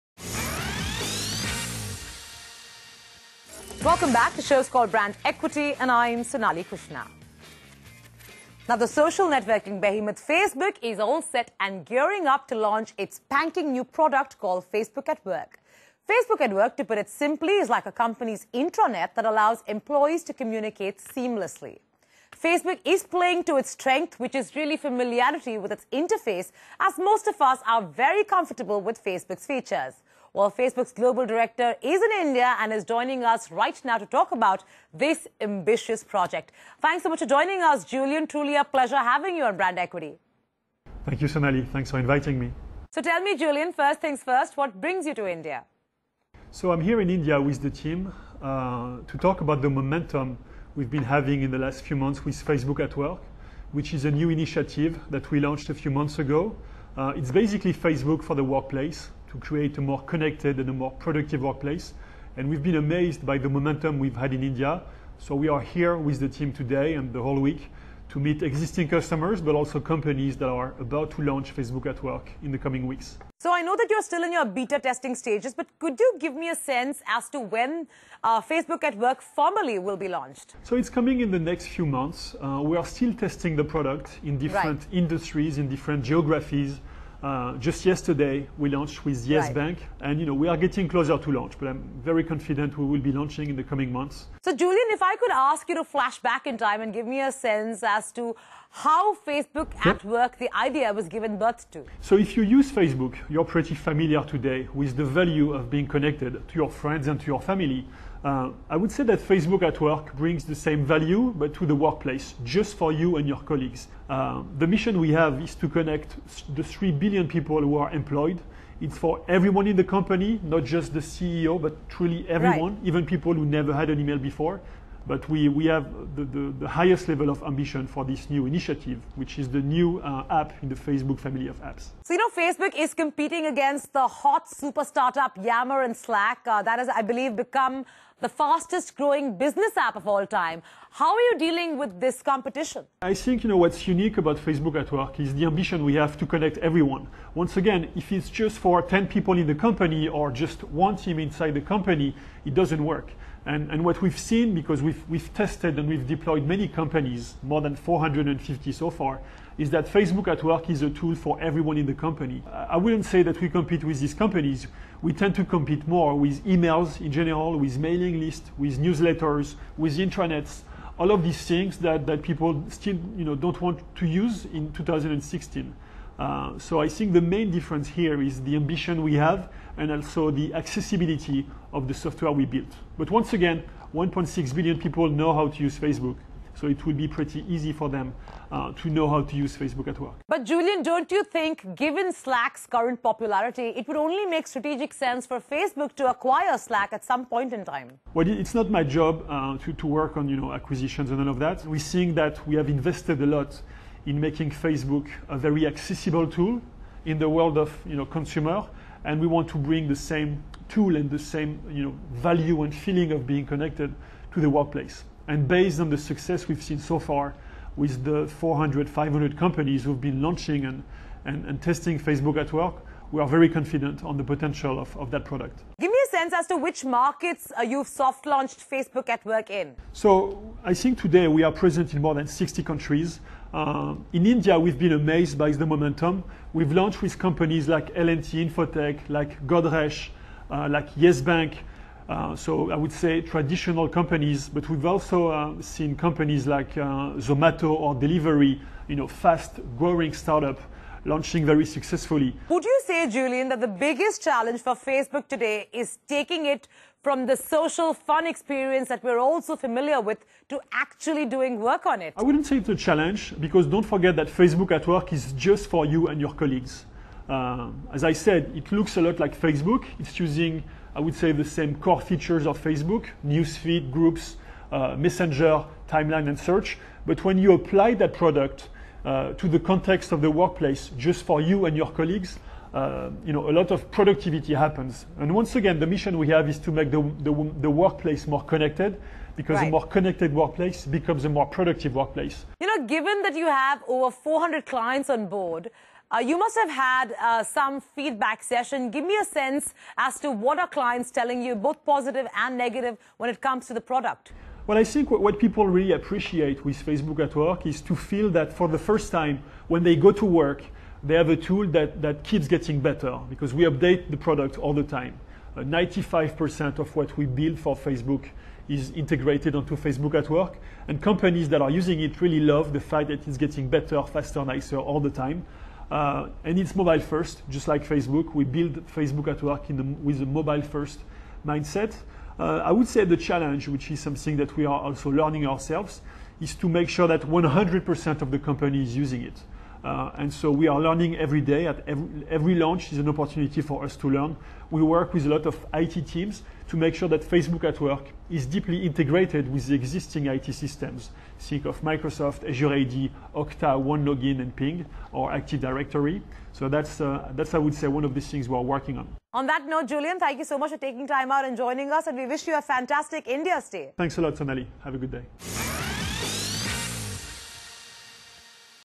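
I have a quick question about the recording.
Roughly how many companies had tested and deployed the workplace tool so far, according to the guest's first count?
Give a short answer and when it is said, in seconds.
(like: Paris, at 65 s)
more than 450, at 157 s.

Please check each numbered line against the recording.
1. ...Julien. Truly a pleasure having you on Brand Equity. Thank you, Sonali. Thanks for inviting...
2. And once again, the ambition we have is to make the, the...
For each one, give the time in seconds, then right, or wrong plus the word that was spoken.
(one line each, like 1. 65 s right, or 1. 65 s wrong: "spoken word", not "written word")
1. 37 s right
2. 285 s wrong: "mission", not "ambition".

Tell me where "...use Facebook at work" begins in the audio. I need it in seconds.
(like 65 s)
189 s.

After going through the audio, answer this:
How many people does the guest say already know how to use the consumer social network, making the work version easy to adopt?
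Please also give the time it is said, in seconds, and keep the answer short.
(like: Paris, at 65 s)
1.6 billion, at 183 s.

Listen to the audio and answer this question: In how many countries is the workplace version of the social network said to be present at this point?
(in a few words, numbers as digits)
more than 60.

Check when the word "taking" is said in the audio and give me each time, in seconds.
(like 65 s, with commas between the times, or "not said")
256 s, 360 s.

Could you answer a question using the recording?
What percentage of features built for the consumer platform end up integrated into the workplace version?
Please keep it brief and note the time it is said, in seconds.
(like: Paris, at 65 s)
95%, at 315 s.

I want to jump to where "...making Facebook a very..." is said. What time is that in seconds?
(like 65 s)
204 s.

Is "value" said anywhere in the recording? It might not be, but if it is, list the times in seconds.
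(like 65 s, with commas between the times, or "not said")
105 s, 110 s, 212 s.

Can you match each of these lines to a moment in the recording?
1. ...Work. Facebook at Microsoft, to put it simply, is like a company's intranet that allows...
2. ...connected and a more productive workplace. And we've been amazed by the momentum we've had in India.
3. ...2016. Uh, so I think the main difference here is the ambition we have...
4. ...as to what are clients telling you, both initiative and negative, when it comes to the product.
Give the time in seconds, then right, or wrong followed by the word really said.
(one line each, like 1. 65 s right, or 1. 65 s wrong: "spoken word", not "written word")
1. 15 s wrong: "Work", not "Microsoft"
2. 60 s right
3. 174 s right
4. 299 s wrong: "positive", not "initiative".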